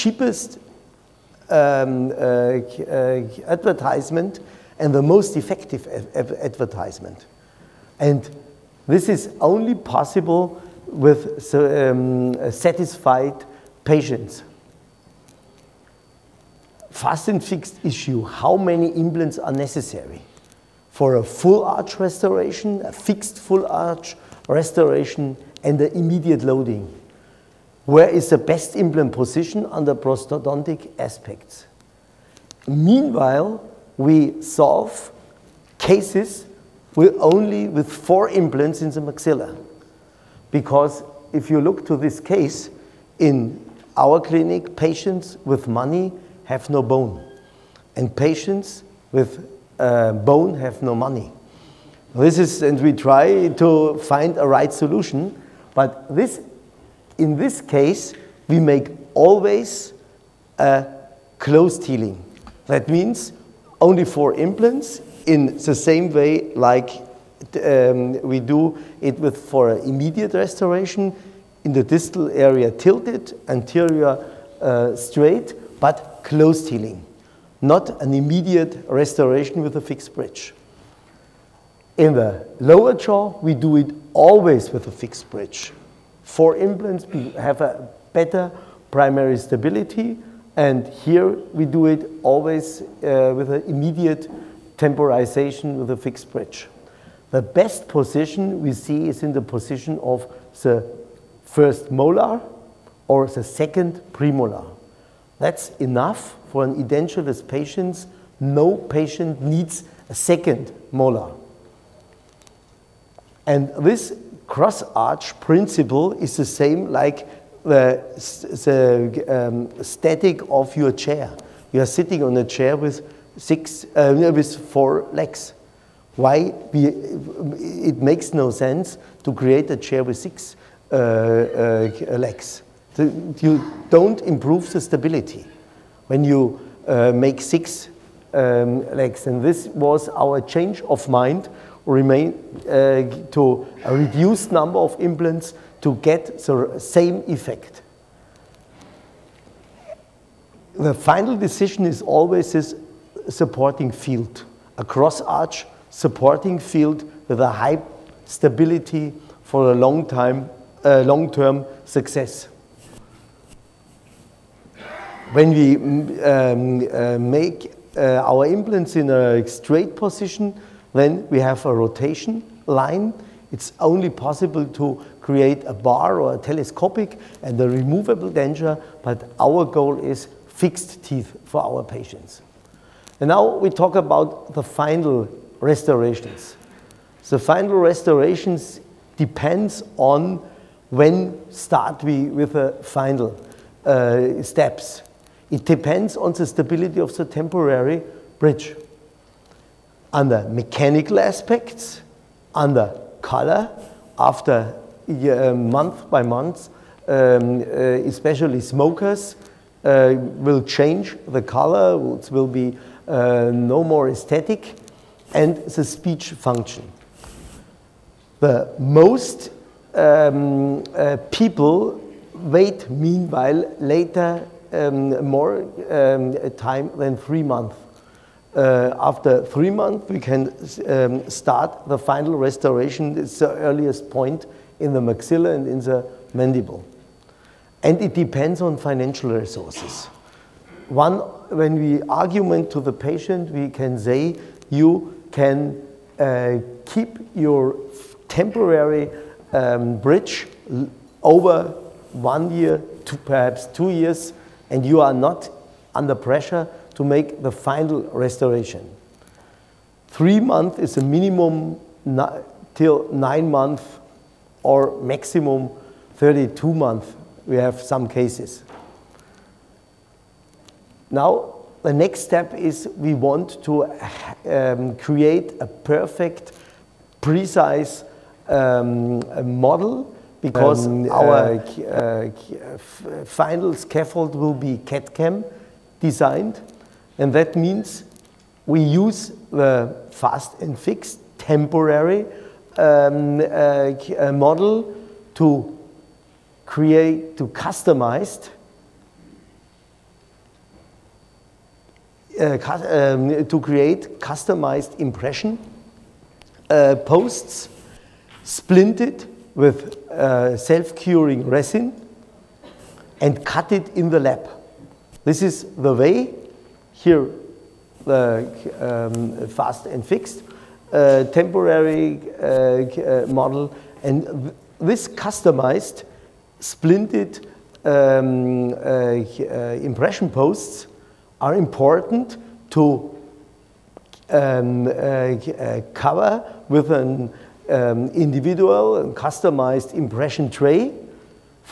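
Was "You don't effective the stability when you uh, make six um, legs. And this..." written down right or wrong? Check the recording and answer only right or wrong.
wrong.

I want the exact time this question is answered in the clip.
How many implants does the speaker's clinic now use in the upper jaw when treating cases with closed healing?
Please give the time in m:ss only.
0:37.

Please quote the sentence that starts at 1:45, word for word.
That's enough for an edentulous patient.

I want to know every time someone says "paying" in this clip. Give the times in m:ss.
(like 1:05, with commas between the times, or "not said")
not said.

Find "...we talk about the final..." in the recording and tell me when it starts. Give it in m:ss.
3:03.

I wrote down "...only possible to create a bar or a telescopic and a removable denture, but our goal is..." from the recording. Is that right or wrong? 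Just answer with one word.
right.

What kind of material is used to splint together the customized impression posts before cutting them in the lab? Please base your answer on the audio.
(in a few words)
Self-curing resin.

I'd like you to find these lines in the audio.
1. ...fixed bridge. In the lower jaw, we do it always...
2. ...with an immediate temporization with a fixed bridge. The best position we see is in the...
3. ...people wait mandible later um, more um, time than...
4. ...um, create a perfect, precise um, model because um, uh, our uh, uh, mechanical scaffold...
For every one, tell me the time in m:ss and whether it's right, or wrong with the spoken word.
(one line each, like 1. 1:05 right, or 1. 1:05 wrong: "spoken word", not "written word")
1. 1:19 right
2. 1:33 right
3. 3:41 wrong: "meanwhile", not "mandible"
4. 4:34 wrong: "final", not "mechanical".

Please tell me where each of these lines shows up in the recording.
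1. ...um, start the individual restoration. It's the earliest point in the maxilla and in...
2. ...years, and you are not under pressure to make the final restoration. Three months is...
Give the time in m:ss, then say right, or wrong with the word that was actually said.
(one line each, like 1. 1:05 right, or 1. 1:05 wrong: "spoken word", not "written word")
1. 3:50 wrong: "final", not "individual"
2. 4:13 right.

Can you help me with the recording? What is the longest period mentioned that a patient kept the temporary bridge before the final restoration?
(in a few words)
32 months.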